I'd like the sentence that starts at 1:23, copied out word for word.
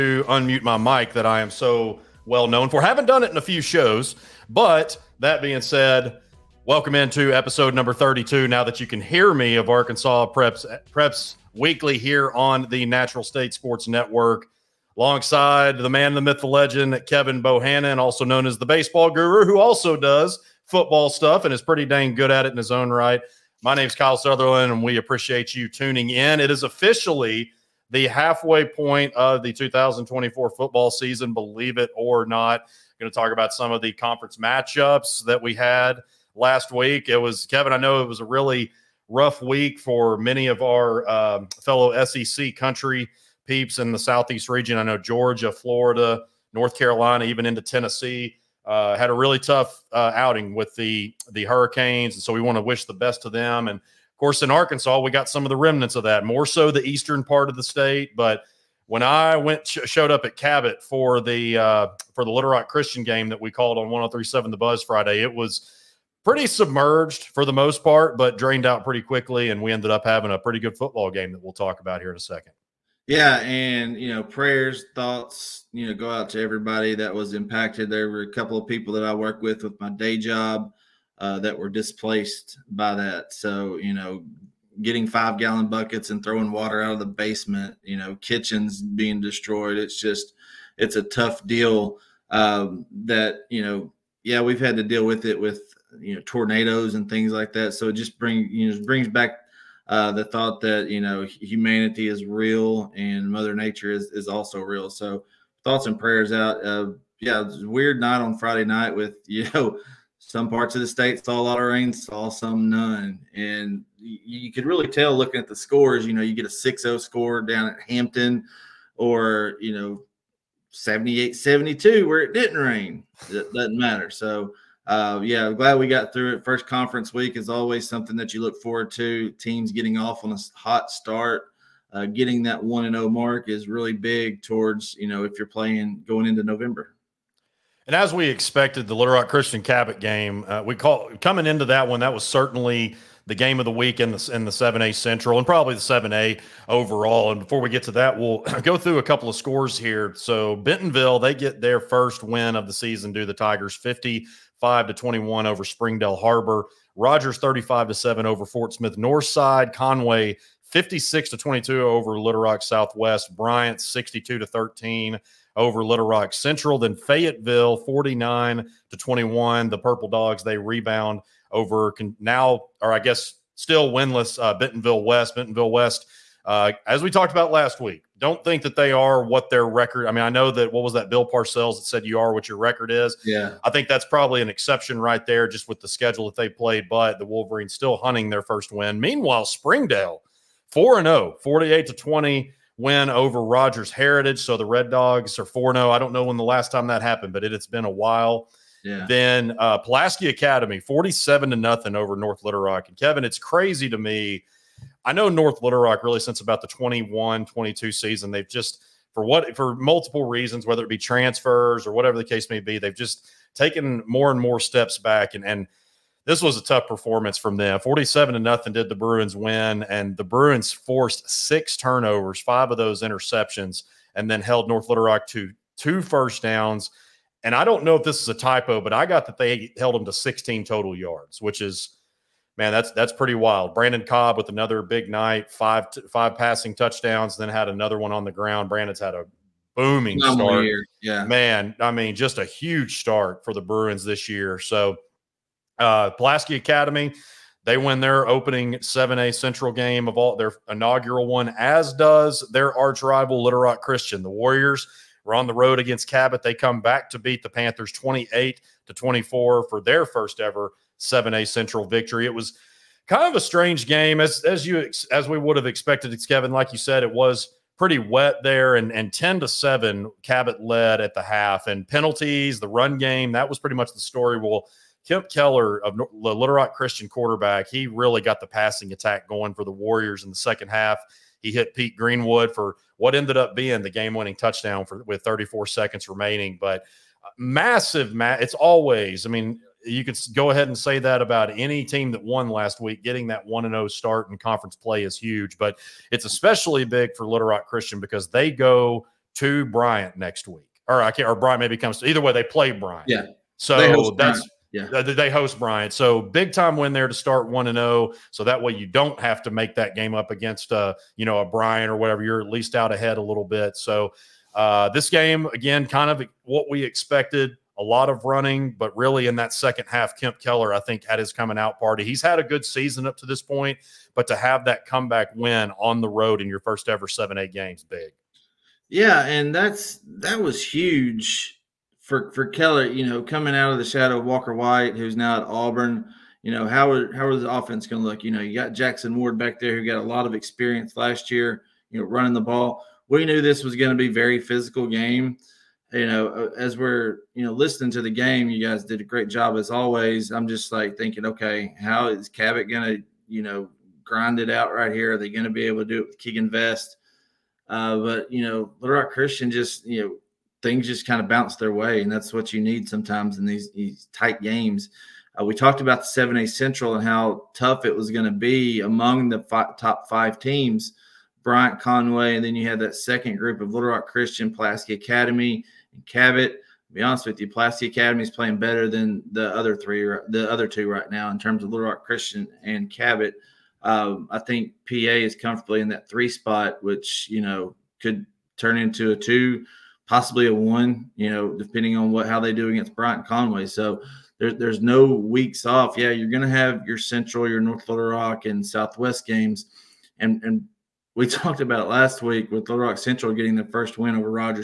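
So you know, getting five gallon buckets and throwing water out of the basement, you know, kitchens being destroyed.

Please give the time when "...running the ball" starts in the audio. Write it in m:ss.
5:42.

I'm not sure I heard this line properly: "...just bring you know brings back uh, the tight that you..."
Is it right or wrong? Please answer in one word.
wrong.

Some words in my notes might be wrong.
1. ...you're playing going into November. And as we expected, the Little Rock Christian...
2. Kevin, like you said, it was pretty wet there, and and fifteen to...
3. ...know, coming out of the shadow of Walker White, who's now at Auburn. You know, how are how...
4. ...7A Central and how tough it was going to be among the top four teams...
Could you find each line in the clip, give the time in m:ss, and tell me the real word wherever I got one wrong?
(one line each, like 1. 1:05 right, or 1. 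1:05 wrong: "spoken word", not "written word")
1. 2:15 right
2. 4:26 wrong: "ten", not "fifteen"
3. 5:33 right
4. 6:06 wrong: "five", not "four".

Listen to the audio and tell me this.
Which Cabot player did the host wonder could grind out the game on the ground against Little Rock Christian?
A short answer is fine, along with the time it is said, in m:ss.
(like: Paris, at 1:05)
Keegan Vest, at 5:56.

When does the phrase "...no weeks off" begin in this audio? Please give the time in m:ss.
6:34.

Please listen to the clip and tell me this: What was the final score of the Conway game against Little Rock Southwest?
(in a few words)
56 to 22.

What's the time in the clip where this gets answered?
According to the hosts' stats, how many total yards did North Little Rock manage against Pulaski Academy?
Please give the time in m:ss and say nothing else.
3:50.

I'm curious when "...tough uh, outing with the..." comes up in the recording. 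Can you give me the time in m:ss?
0:49.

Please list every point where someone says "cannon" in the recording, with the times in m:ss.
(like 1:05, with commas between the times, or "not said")
not said.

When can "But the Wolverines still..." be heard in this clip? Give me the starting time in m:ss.
3:06.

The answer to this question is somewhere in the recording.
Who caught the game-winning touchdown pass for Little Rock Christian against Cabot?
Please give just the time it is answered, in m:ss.
4:41.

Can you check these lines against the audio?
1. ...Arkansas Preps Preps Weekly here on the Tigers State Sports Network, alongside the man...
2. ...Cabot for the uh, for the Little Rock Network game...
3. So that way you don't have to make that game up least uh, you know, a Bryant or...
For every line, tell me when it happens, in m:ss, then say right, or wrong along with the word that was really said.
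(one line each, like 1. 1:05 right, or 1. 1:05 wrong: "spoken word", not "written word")
1. 0:09 wrong: "Natural", not "Tigers"
2. 1:00 wrong: "Christian", not "Network"
3. 5:08 wrong: "against", not "least".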